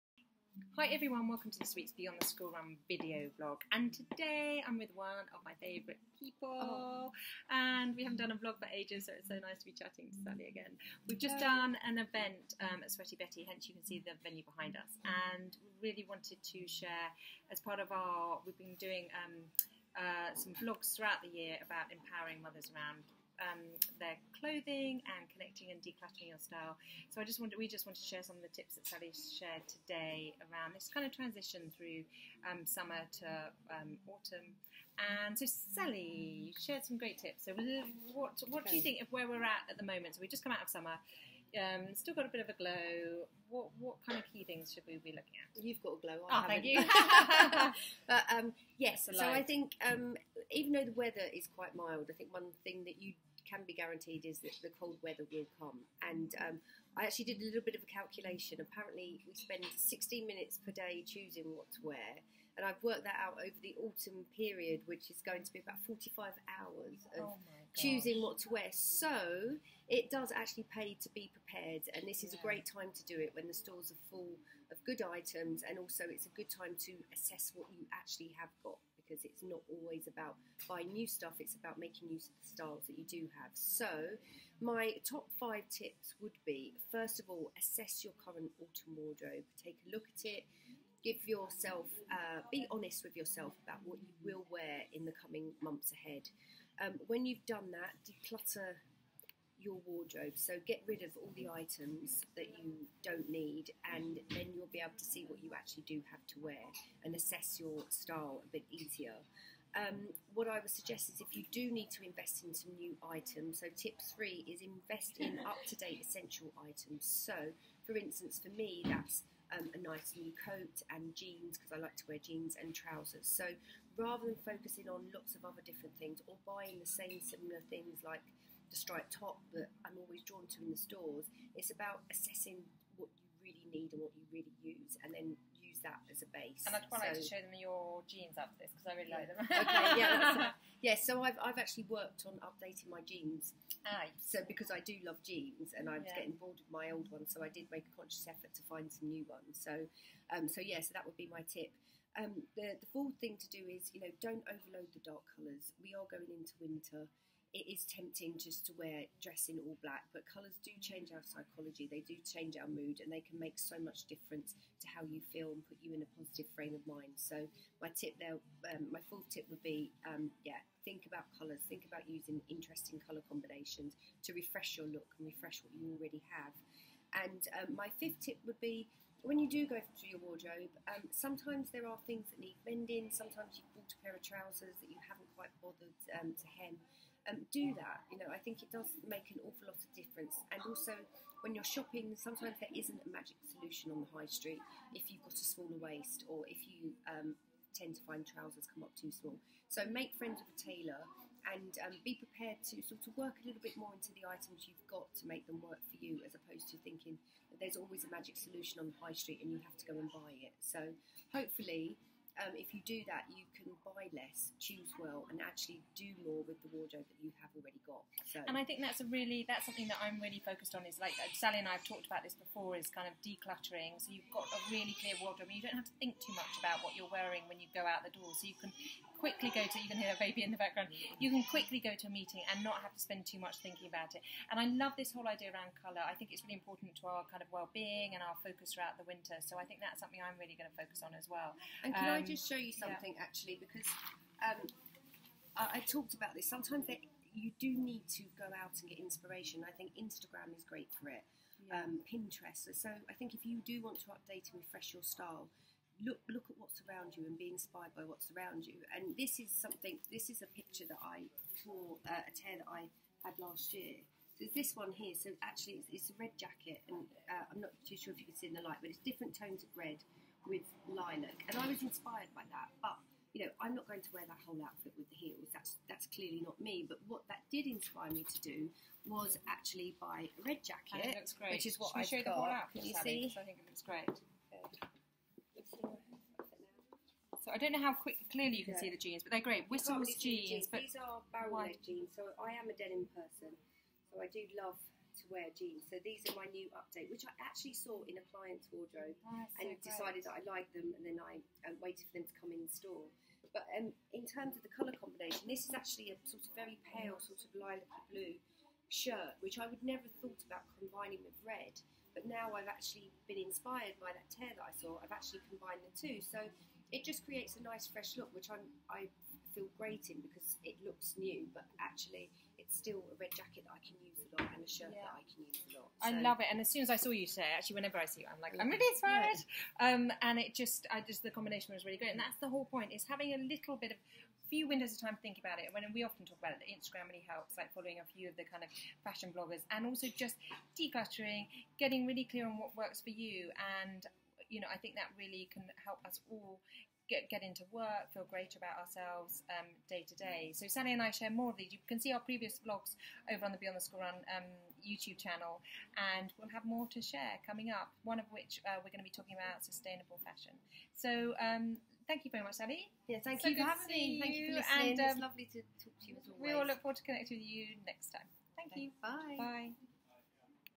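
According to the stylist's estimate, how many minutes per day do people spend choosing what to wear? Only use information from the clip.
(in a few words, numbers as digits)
16 minutes.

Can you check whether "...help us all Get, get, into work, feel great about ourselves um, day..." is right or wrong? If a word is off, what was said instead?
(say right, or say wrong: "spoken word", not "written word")
right.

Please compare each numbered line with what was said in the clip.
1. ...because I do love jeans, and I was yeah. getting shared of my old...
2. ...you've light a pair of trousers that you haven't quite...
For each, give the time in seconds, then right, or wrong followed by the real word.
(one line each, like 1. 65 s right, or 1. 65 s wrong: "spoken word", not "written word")
1. 144 s wrong: "bored", not "shared"
2. 183 s wrong: "bought", not "light".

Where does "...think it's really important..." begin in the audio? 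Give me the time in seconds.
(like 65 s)
236 s.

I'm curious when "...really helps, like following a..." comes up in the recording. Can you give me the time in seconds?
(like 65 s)
337 s.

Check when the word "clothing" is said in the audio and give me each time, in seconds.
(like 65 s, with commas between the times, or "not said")
24 s.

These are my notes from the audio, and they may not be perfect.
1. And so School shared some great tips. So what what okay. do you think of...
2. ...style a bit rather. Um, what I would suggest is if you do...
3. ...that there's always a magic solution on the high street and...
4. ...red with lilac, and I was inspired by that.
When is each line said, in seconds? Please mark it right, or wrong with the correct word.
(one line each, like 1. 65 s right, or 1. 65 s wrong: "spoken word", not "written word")
1. 35 s wrong: "Sally", not "School"
2. 107 s wrong: "easier", not "rather"
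3. 207 s right
4. 269 s right.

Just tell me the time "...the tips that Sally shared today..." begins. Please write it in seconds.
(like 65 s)
28 s.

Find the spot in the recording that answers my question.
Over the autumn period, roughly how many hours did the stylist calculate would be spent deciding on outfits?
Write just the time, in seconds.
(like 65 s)
65 s.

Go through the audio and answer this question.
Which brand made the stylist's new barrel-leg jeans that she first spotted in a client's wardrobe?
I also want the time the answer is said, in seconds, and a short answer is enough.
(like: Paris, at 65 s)
Whistles, at 289 s.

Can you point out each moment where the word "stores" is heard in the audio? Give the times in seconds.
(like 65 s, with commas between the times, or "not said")
73 s, 130 s, 302 s.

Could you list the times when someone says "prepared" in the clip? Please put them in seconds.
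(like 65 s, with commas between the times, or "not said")
71 s, 202 s.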